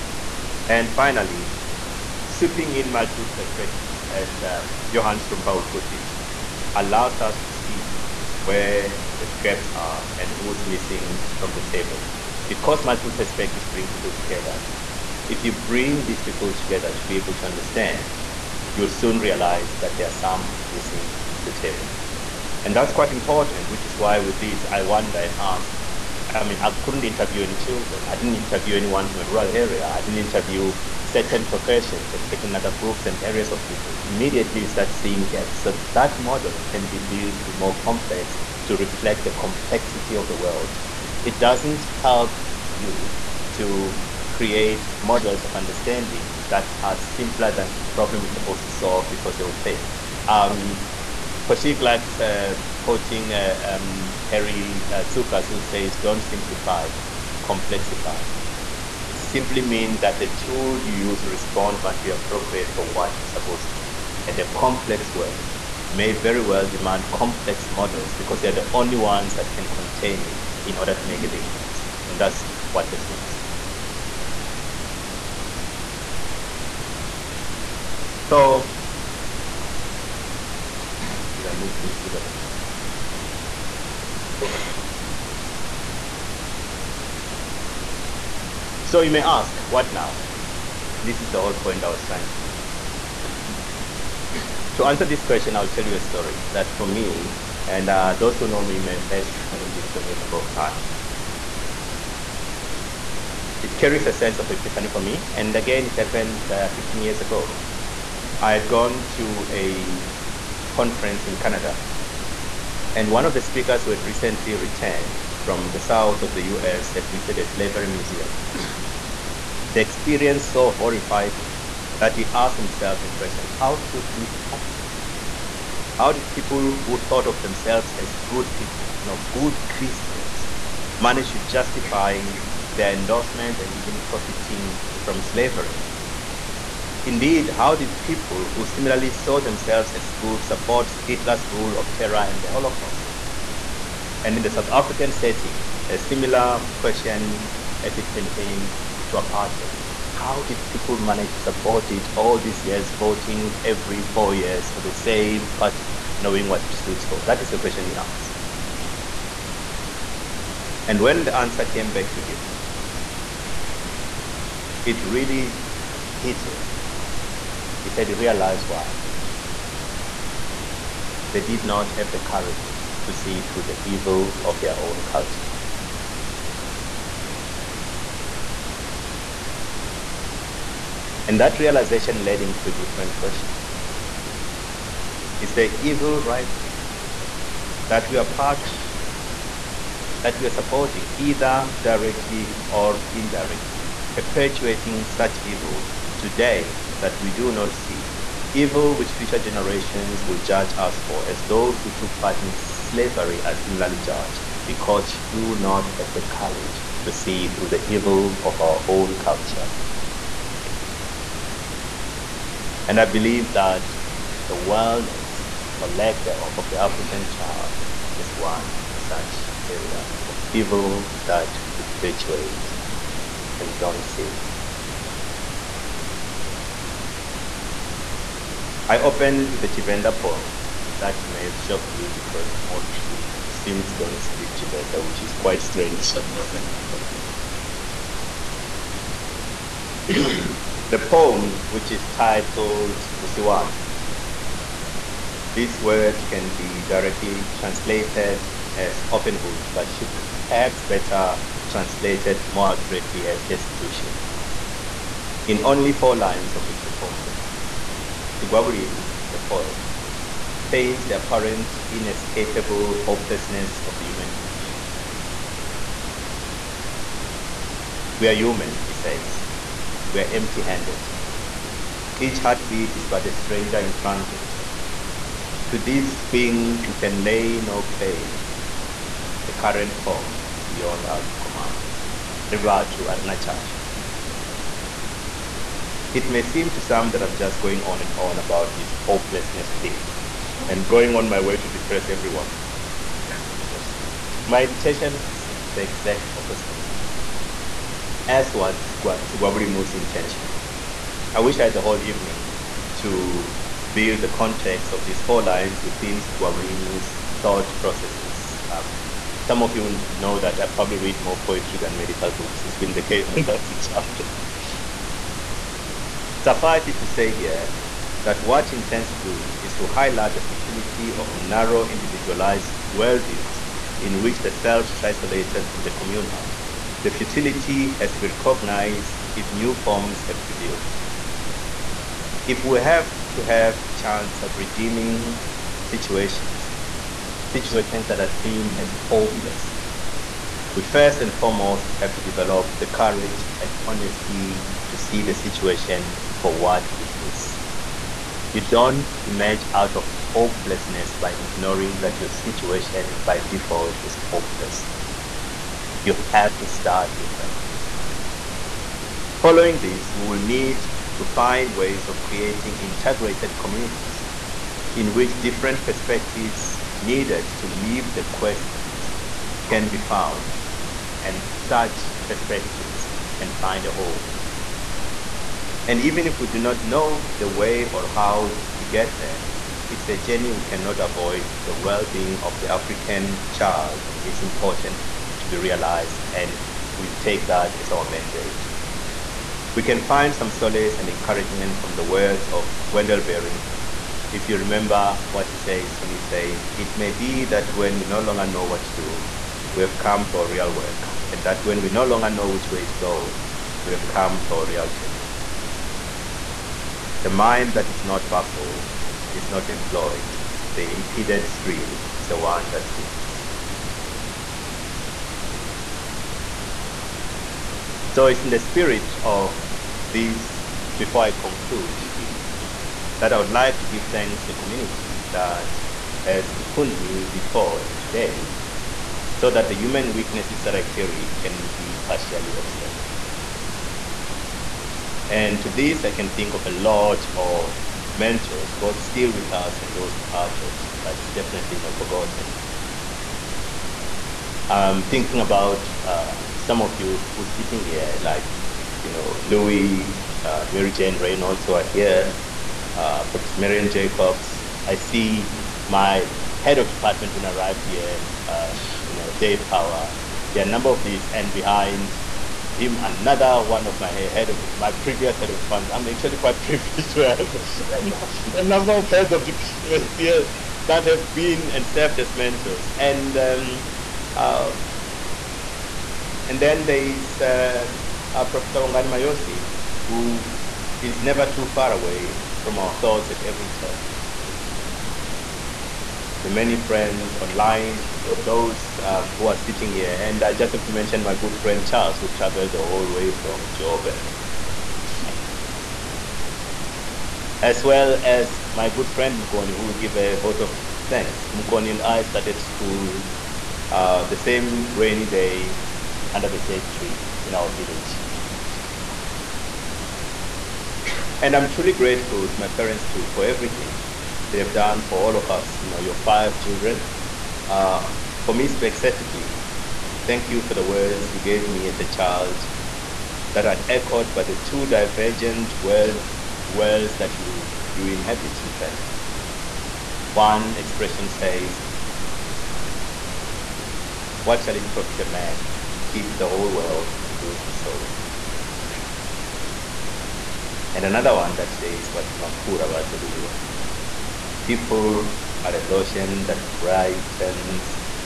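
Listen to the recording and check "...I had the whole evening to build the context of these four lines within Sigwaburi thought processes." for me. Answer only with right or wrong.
right.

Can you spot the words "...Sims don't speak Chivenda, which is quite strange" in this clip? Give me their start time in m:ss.
3:53.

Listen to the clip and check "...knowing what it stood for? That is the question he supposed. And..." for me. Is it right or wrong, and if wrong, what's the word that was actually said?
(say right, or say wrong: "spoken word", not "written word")
wrong: "asked", not "supposed".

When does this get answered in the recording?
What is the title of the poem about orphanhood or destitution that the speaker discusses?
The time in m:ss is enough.
4:03.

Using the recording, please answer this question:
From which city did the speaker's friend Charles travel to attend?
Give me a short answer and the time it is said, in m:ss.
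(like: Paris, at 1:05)
Joburg, at 8:13.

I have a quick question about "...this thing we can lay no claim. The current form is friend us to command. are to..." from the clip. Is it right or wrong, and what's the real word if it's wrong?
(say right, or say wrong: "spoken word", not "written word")
wrong: "beyond", not "friend".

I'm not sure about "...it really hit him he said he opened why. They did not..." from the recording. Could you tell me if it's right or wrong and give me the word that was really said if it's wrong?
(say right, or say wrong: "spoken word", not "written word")
wrong: "realized", not "opened".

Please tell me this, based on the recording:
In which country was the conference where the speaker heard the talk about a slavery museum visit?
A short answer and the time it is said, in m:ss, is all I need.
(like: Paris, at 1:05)
Canada, at 1:51.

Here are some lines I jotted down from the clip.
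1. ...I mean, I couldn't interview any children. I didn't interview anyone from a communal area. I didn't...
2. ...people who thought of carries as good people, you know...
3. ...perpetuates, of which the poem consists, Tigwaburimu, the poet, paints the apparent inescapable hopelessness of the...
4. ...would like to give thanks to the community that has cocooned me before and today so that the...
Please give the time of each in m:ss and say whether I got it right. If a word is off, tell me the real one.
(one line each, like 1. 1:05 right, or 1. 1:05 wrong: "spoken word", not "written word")
1. 0:26 wrong: "rural", not "communal"
2. 2:06 wrong: "themselves", not "carries"
3. 4:16 wrong: "lines", not "perpetuates"
4. 7:03 right.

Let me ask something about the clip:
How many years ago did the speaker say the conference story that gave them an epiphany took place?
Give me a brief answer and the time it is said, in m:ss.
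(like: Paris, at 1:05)
15, at 1:46.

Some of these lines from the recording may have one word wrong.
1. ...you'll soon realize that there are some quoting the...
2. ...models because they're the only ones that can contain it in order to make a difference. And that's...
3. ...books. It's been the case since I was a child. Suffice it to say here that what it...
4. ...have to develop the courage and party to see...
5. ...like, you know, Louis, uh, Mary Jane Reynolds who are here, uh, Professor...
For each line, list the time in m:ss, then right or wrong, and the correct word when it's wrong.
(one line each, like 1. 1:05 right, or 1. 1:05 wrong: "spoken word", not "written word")
1. 0:18 wrong: "missing", not "quoting"
2. 1:07 right
3. 5:12 right
4. 5:42 wrong: "honesty", not "party"
5. 7:28 right.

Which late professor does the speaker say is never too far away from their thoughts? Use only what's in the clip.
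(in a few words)
Bongani Mayosi.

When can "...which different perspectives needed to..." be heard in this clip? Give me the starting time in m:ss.
6:05.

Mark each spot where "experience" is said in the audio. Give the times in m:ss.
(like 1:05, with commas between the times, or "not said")
1:59.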